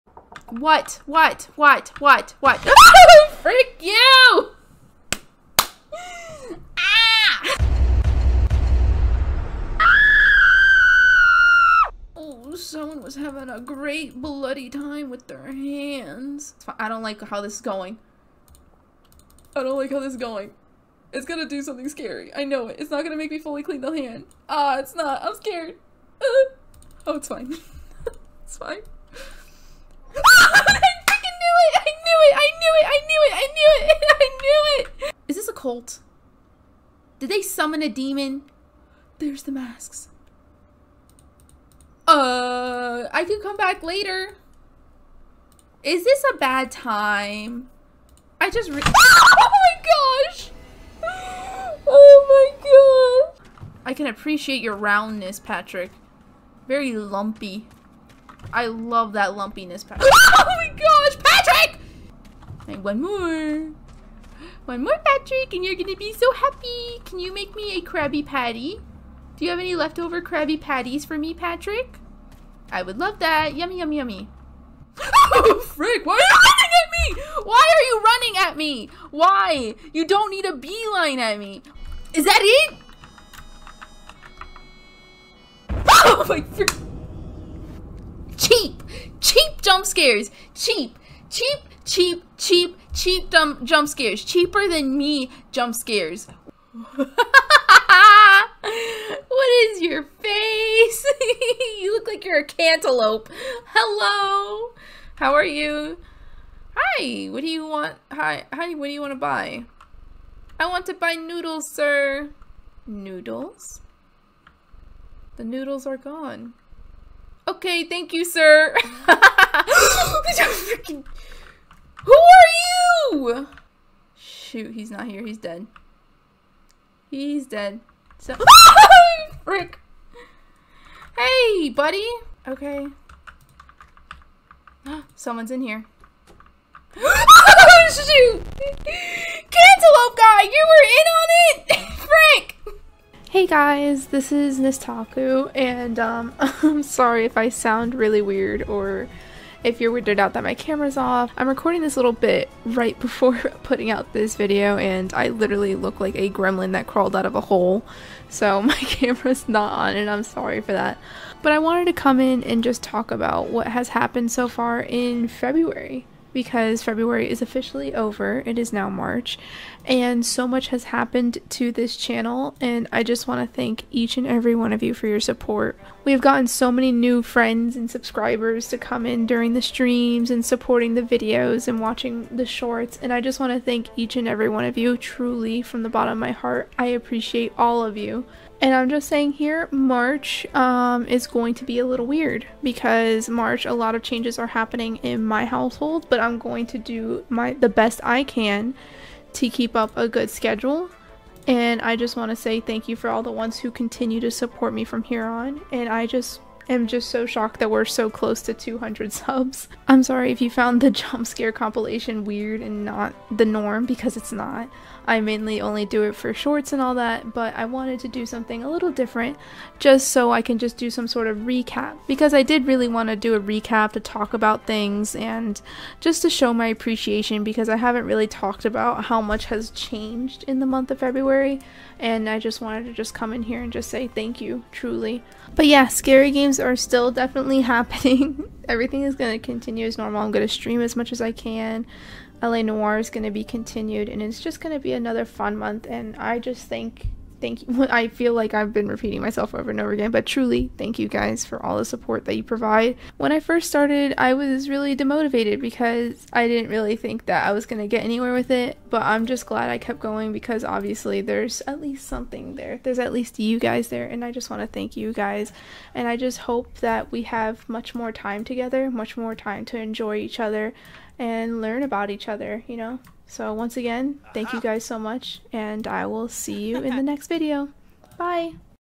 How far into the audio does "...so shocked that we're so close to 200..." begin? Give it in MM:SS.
03:27.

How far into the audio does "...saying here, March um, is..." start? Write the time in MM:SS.
03:09.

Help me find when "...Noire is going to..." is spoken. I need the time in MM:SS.
04:02.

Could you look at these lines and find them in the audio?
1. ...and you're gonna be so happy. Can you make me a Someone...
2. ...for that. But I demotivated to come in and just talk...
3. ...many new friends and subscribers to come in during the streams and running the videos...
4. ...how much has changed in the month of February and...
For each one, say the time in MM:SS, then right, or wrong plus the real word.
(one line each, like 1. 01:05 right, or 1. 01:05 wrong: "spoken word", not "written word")
1. 01:05 wrong: "Krabby", not "Someone"
2. 02:40 wrong: "wanted", not "demotivated"
3. 02:56 wrong: "supporting", not "running"
4. 03:49 right.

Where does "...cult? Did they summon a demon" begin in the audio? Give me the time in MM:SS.
00:35.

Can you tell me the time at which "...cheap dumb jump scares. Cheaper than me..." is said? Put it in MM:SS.
01:32.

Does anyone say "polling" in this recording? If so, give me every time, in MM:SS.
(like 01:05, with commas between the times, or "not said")
not said.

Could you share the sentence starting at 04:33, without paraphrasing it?
So, once again, thank you guys so much, and I will see you in the next video.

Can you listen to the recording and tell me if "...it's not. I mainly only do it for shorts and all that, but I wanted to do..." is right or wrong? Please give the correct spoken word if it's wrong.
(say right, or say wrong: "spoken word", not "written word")
right.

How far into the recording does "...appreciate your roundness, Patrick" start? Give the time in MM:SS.
00:54.